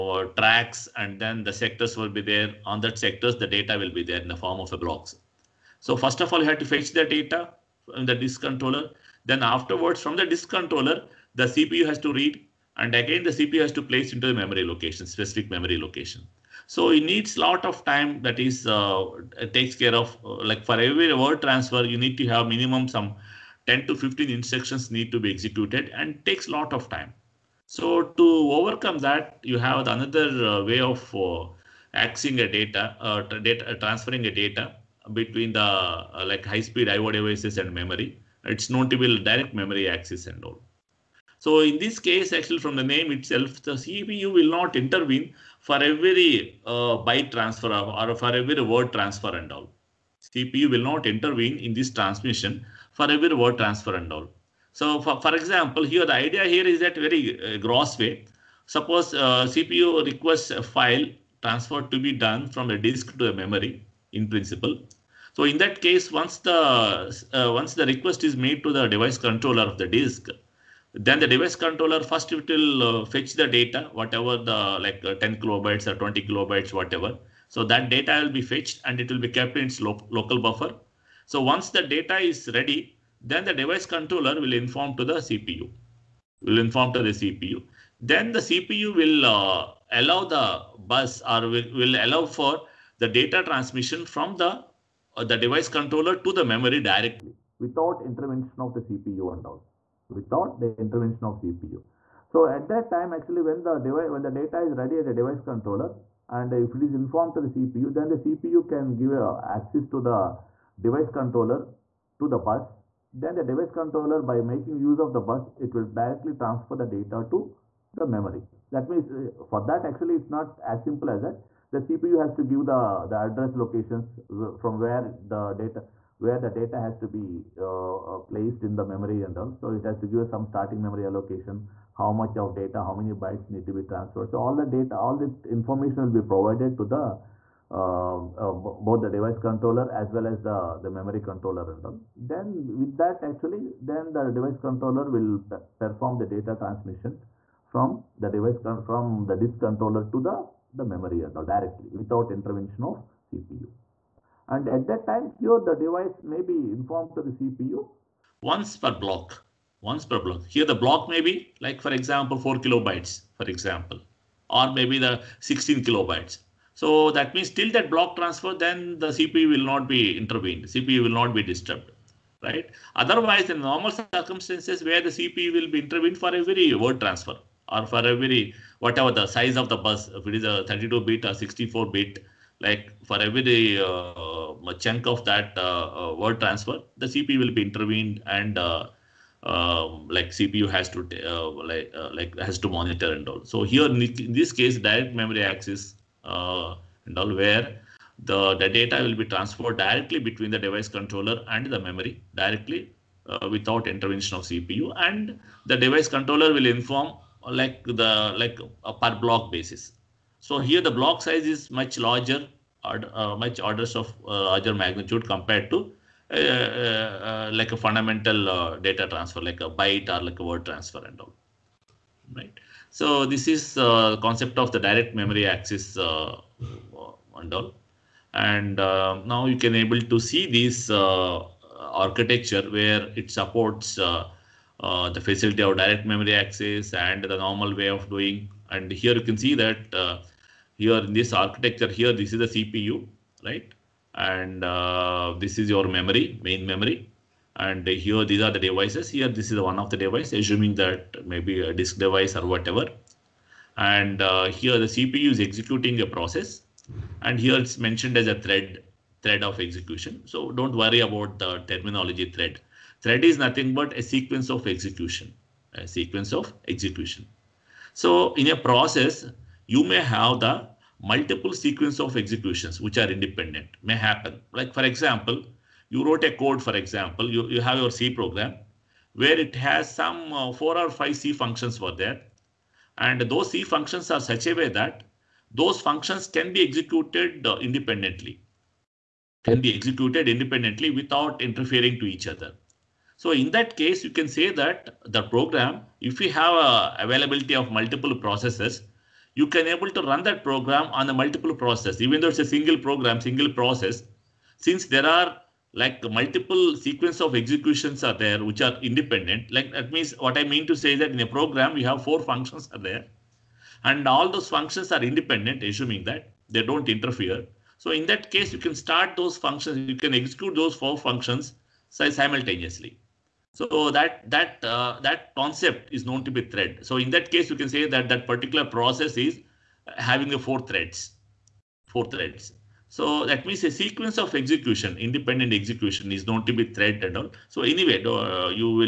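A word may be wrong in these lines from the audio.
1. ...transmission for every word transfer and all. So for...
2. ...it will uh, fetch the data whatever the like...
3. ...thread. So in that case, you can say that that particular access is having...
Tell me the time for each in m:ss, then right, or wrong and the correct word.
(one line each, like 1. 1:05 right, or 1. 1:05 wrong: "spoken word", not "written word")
1. 0:51 right
2. 1:12 right
3. 5:26 wrong: "process", not "access".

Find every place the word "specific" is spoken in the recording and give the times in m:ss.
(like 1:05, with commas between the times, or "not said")
0:15.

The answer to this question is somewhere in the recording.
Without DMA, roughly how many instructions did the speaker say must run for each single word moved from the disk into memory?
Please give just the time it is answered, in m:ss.
0:23.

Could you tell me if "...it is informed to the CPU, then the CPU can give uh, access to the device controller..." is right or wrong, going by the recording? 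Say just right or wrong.
right.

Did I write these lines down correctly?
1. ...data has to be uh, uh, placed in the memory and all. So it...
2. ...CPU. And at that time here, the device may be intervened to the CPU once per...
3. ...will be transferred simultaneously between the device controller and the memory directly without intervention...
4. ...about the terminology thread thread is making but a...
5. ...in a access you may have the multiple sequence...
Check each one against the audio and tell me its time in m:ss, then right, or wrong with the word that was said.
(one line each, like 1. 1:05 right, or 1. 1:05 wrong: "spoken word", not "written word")
1. 2:06 right
2. 2:33 wrong: "informed", not "intervened"
3. 3:19 wrong: "directly", not "simultaneously"
4. 4:21 wrong: "nothing", not "making"
5. 4:28 wrong: "process", not "access".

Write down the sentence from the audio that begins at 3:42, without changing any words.
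So this is the concept of the direct memory access and all.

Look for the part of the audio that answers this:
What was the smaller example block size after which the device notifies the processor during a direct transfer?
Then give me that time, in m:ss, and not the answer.
2:42.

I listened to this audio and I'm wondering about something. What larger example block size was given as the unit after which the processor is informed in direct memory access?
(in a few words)
16 kilobytes.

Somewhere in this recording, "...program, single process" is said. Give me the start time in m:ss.
5:02.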